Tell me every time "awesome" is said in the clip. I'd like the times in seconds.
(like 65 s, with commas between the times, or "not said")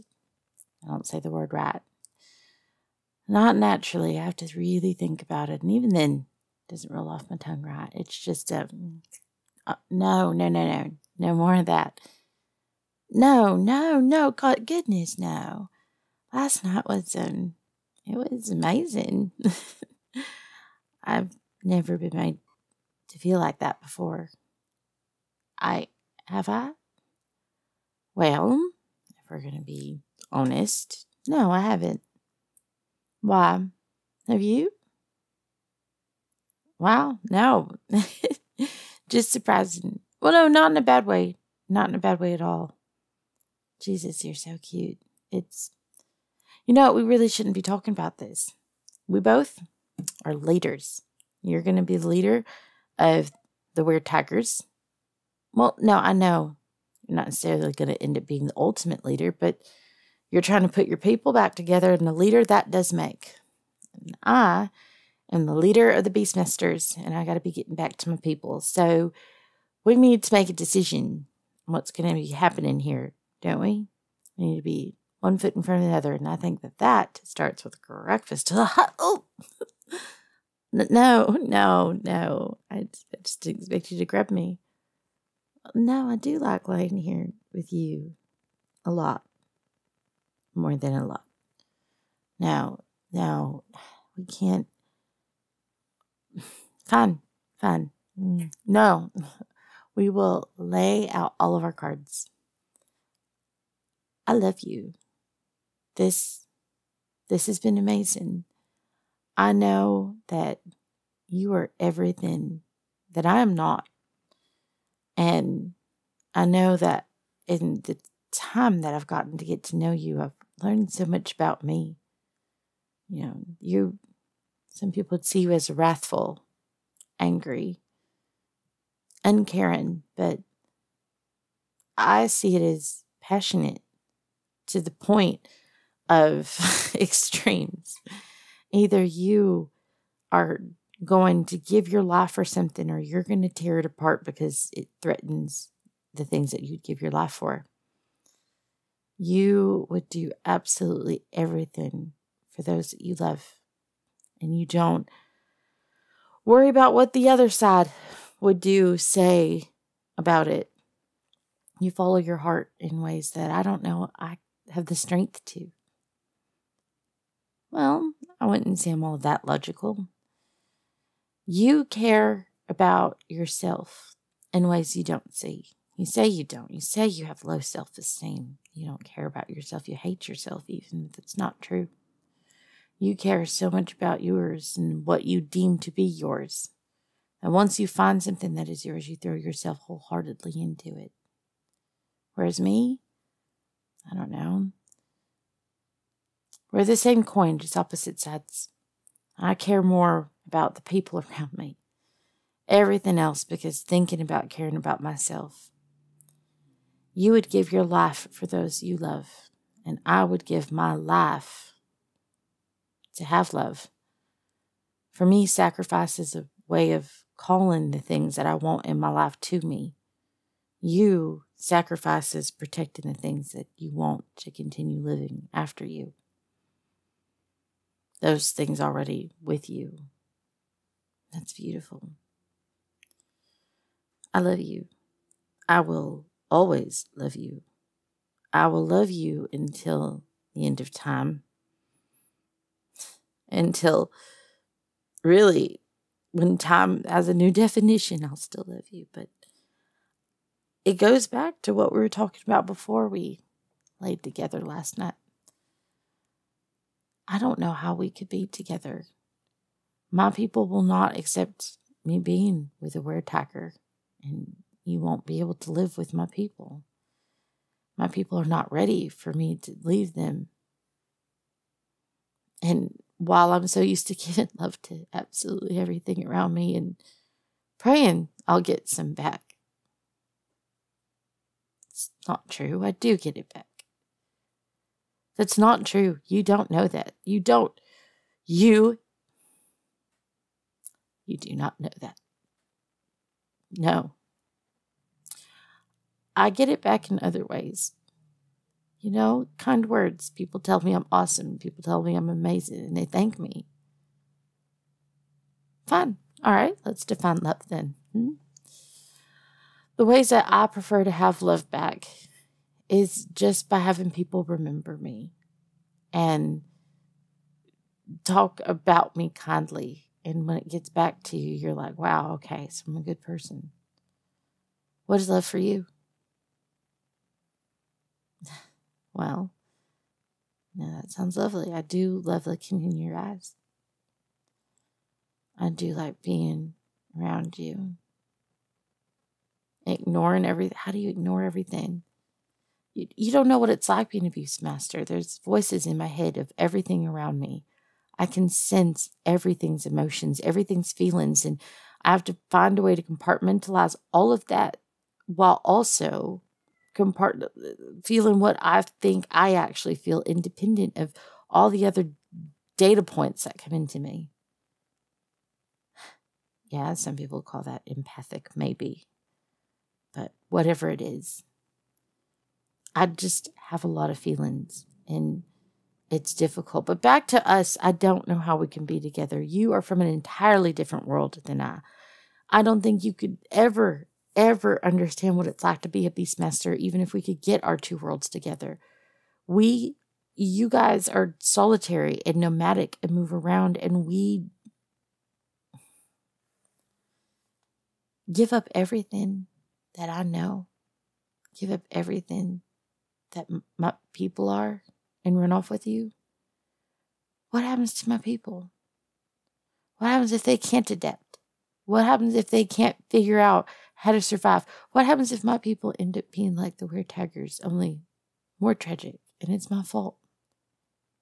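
301 s.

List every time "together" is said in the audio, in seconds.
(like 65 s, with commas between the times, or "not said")
61 s, 254 s, 258 s, 378 s, 388 s.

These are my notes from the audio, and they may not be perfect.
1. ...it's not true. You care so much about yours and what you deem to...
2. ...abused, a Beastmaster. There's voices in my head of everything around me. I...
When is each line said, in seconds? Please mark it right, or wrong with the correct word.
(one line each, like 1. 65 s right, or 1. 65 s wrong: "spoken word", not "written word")
1. 181 s right
2. 344 s right.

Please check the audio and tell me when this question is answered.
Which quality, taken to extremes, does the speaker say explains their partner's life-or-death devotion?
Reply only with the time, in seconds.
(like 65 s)
133 s.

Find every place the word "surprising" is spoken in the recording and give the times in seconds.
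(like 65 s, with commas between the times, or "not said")
39 s.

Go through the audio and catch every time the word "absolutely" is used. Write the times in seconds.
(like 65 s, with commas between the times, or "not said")
150 s, 275 s.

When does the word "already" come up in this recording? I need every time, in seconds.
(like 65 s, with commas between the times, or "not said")
228 s.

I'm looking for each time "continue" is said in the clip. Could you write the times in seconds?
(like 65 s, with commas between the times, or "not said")
224 s.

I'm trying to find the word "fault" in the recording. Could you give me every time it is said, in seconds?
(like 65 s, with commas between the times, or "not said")
419 s.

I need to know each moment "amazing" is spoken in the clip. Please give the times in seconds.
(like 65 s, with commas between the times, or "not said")
18 s, 107 s, 302 s.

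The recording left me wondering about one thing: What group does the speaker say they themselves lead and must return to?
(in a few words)
Beastmasters.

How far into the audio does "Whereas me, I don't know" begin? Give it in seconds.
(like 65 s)
192 s.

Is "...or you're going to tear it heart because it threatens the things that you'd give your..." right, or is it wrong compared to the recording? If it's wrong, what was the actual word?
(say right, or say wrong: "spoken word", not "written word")
wrong: "apart", not "heart".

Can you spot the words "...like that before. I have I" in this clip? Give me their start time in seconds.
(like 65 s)
23 s.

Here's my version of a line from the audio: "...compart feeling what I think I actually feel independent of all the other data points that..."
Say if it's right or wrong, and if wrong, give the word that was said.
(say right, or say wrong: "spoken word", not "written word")
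right.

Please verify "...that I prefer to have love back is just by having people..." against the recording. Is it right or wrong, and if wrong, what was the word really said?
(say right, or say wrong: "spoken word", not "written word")
right.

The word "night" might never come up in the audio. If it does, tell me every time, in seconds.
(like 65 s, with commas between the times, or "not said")
16 s, 254 s.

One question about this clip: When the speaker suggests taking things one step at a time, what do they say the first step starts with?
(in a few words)
breakfast.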